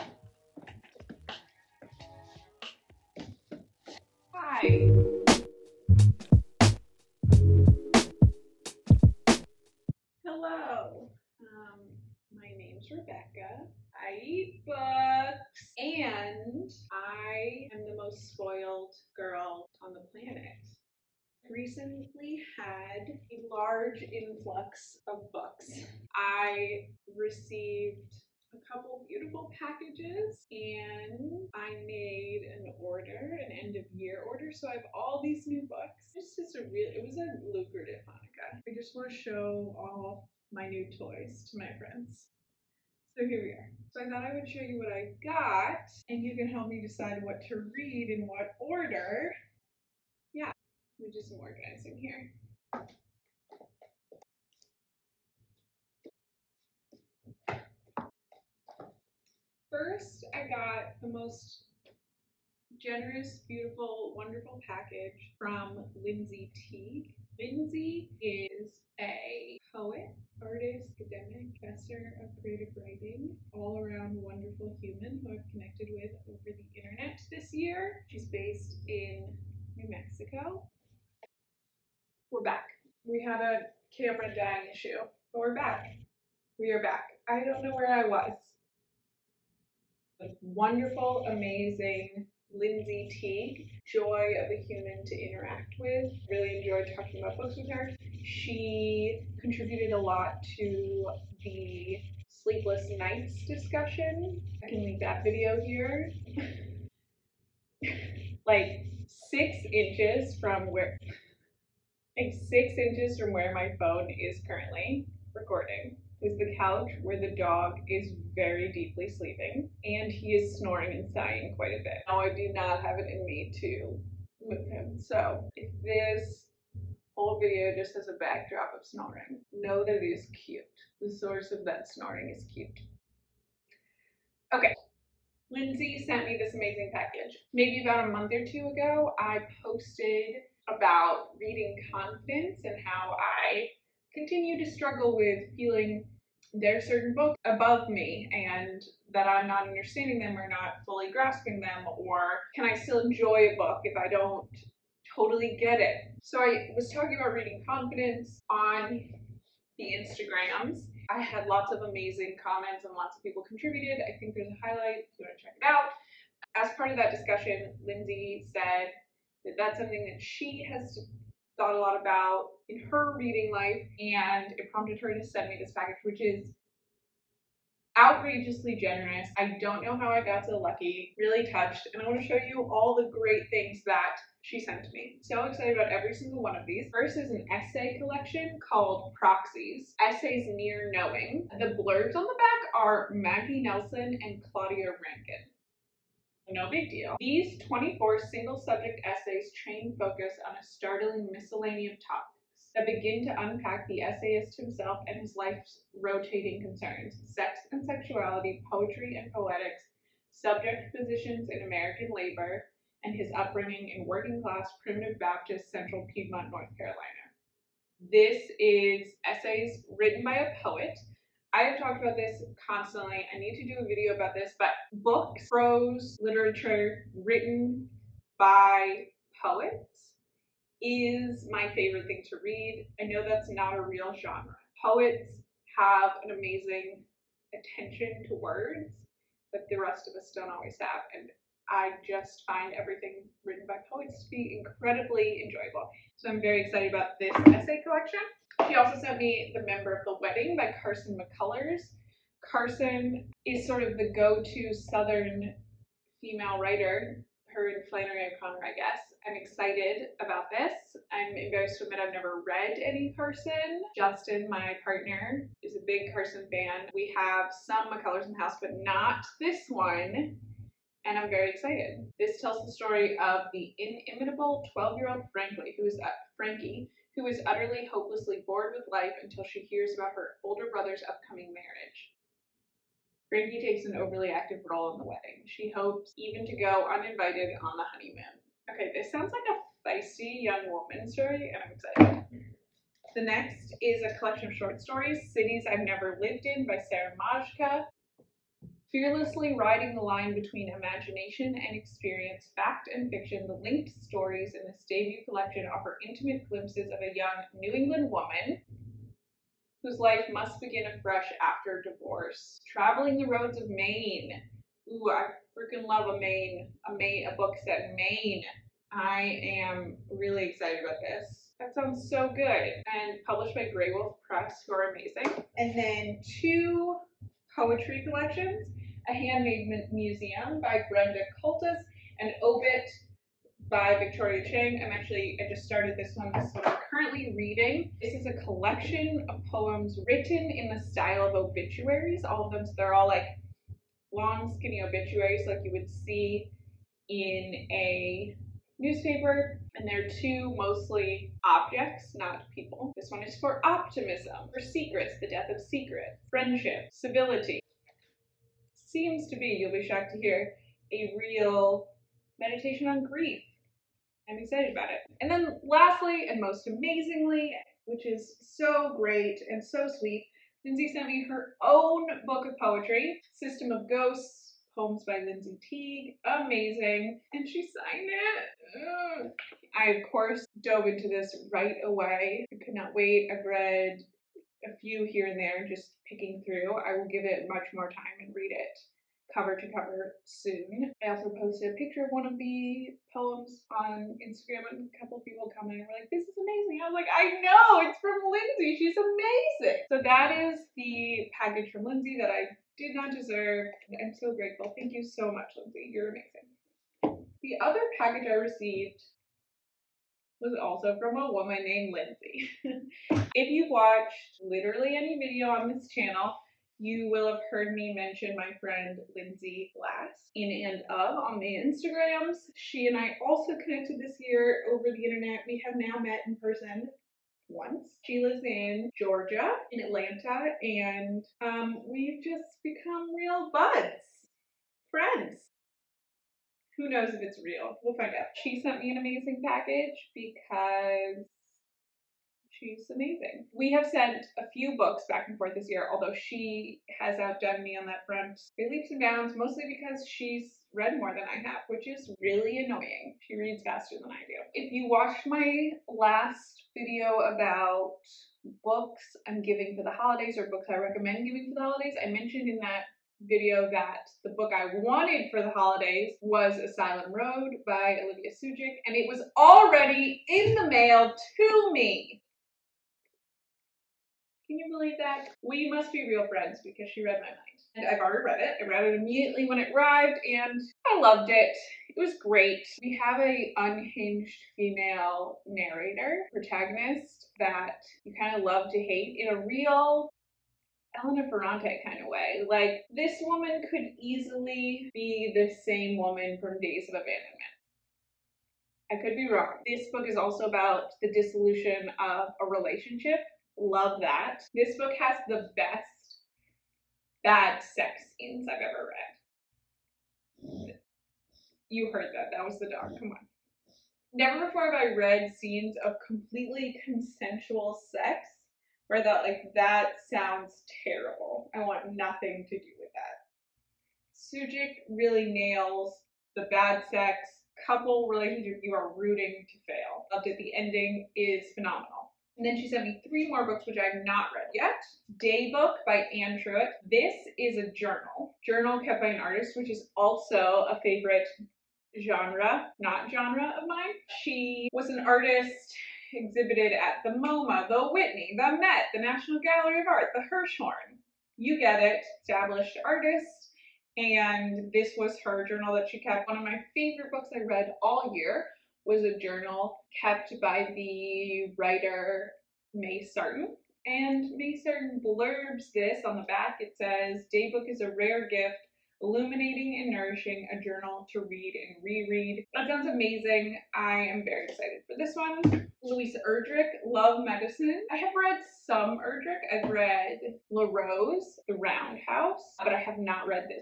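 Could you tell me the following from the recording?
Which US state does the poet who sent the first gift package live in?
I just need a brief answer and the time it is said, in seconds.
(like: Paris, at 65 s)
New Mexico, at 79 s.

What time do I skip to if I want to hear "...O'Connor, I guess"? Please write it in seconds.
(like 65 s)
258 s.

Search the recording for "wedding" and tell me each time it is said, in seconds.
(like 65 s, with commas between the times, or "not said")
250 s, 285 s.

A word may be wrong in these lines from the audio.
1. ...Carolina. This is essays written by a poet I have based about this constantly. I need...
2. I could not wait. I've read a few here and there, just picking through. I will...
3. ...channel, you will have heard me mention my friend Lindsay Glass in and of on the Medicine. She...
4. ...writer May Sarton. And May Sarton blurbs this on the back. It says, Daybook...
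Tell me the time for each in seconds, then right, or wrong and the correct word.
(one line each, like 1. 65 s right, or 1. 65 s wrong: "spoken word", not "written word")
1. 216 s wrong: "talked", not "based"
2. 382 s right
3. 415 s wrong: "Instagrams", not "Medicine"
4. 561 s right.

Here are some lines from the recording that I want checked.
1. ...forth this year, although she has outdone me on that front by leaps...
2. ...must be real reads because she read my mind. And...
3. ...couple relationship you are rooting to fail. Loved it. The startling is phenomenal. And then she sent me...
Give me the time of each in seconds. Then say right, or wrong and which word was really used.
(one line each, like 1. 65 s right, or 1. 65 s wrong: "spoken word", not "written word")
1. 445 s right
2. 475 s wrong: "friends", not "reads"
3. 527 s wrong: "ending", not "startling".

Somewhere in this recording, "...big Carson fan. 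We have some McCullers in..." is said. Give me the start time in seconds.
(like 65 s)
265 s.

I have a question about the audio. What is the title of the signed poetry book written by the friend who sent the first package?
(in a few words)
System of Ghosts.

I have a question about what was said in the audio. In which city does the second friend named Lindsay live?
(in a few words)
Atlanta.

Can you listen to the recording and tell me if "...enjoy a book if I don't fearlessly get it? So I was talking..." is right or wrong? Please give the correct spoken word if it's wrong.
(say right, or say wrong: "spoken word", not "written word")
wrong: "totally", not "fearlessly".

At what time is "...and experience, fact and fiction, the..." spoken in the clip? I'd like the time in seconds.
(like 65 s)
301 s.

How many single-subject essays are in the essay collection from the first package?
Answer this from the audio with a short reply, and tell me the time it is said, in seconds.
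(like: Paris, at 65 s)
24, at 197 s.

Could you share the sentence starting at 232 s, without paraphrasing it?
I know that's not a real genre.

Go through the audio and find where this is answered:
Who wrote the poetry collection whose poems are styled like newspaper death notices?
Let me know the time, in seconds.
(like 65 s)
333 s.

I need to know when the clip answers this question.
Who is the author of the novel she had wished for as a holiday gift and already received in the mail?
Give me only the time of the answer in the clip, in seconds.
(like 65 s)
468 s.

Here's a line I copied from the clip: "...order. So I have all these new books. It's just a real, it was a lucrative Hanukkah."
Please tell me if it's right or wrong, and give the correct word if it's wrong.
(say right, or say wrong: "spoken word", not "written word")
right.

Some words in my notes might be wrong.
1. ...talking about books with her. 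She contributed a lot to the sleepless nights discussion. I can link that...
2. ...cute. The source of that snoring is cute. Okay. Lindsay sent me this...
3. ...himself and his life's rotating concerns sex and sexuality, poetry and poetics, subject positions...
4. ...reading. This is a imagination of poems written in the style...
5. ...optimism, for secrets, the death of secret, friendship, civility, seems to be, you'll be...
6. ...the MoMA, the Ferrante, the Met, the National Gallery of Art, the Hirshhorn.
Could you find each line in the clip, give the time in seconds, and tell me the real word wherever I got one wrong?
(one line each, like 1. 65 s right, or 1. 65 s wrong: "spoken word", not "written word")
1. 96 s right
2. 130 s right
3. 204 s right
4. 337 s wrong: "collection", not "imagination"
5. 353 s right
6. 547 s wrong: "Whitney", not "Ferrante".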